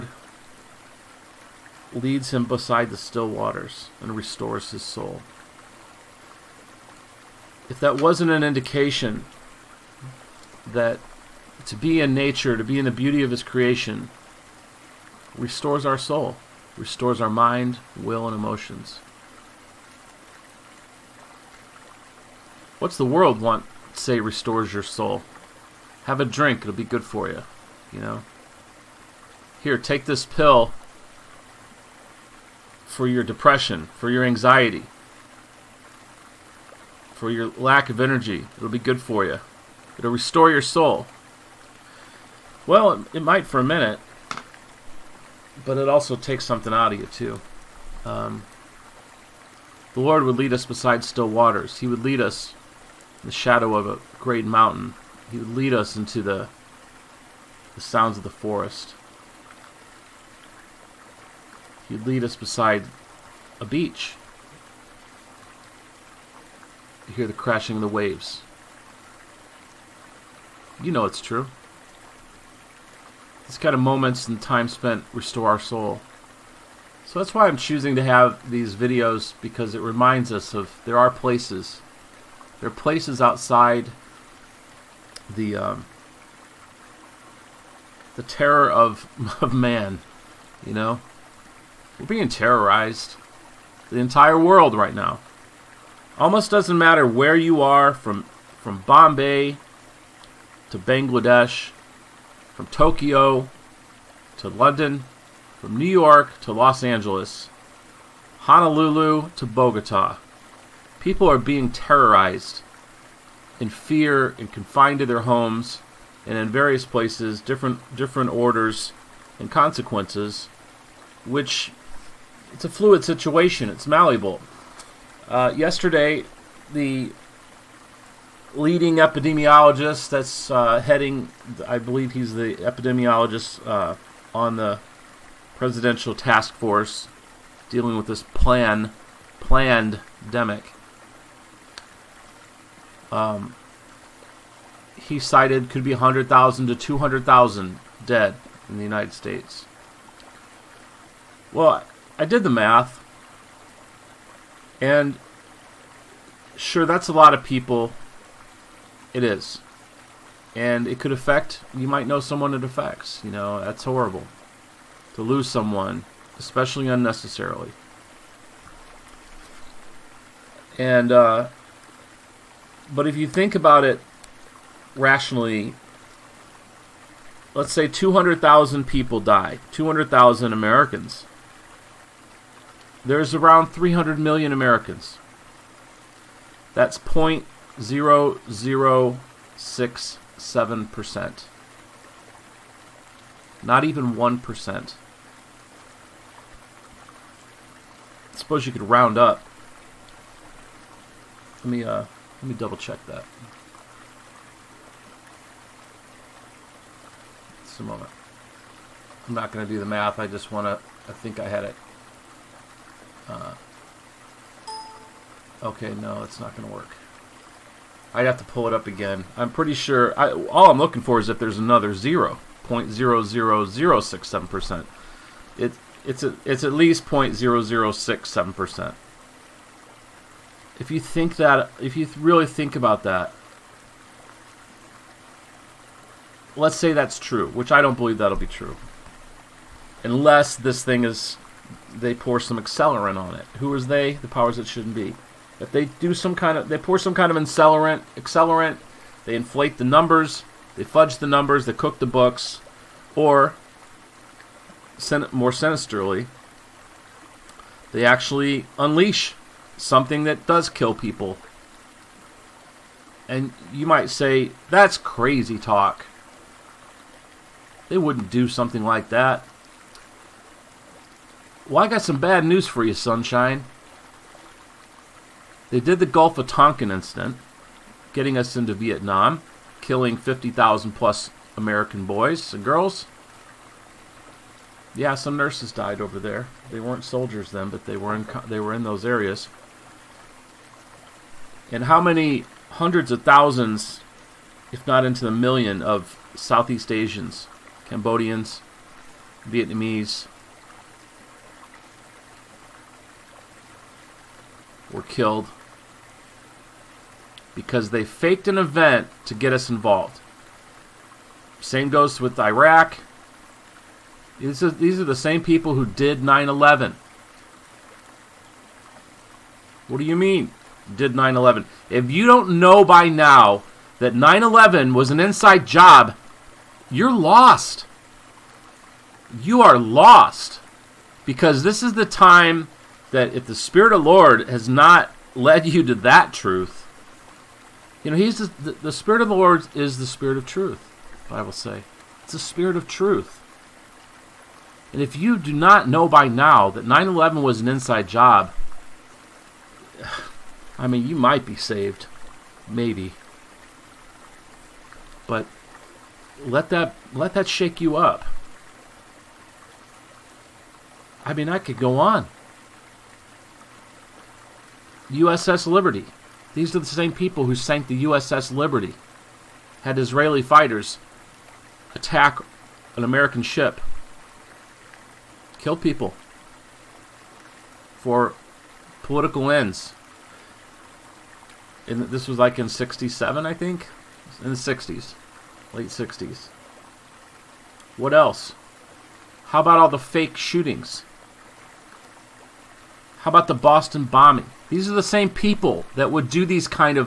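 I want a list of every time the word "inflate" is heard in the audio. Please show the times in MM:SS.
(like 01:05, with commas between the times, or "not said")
04:09.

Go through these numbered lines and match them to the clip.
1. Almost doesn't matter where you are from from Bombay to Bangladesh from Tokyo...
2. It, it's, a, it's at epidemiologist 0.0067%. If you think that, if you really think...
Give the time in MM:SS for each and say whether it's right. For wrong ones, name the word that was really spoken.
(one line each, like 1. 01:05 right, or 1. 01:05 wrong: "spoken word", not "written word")
1. 01:36 right
2. 03:45 wrong: "least", not "epidemiologist".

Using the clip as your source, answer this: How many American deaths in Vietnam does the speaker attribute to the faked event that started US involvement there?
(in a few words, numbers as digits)
50,000 plus.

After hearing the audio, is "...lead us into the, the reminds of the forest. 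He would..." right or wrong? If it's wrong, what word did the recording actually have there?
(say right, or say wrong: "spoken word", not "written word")
wrong: "sounds", not "reminds".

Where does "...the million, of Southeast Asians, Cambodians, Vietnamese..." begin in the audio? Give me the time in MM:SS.
04:55.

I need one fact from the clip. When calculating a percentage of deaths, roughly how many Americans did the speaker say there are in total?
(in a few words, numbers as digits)
300 million.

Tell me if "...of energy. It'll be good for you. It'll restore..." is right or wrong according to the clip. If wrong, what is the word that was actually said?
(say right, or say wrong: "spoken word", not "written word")
right.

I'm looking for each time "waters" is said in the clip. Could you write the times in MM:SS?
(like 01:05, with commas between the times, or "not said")
00:03, 00:51.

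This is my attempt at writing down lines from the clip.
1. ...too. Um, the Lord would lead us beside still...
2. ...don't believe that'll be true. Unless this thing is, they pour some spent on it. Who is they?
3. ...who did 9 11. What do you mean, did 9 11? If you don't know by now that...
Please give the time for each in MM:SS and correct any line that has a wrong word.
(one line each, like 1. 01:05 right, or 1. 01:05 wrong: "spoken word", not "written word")
1. 00:47 right
2. 03:57 wrong: "accelerant", not "spent"
3. 05:15 right.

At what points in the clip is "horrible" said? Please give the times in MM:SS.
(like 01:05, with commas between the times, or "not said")
02:43.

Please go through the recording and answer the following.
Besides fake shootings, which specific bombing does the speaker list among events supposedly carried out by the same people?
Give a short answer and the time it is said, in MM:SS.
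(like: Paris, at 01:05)
Boston bombing, at 06:33.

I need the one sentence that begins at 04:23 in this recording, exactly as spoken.
And you might say, that's crazy talk.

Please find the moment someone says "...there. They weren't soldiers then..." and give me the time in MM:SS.
04:46.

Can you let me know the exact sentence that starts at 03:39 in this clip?
I'm pretty sure, I, all I'm looking for is if there's another 0.00067%.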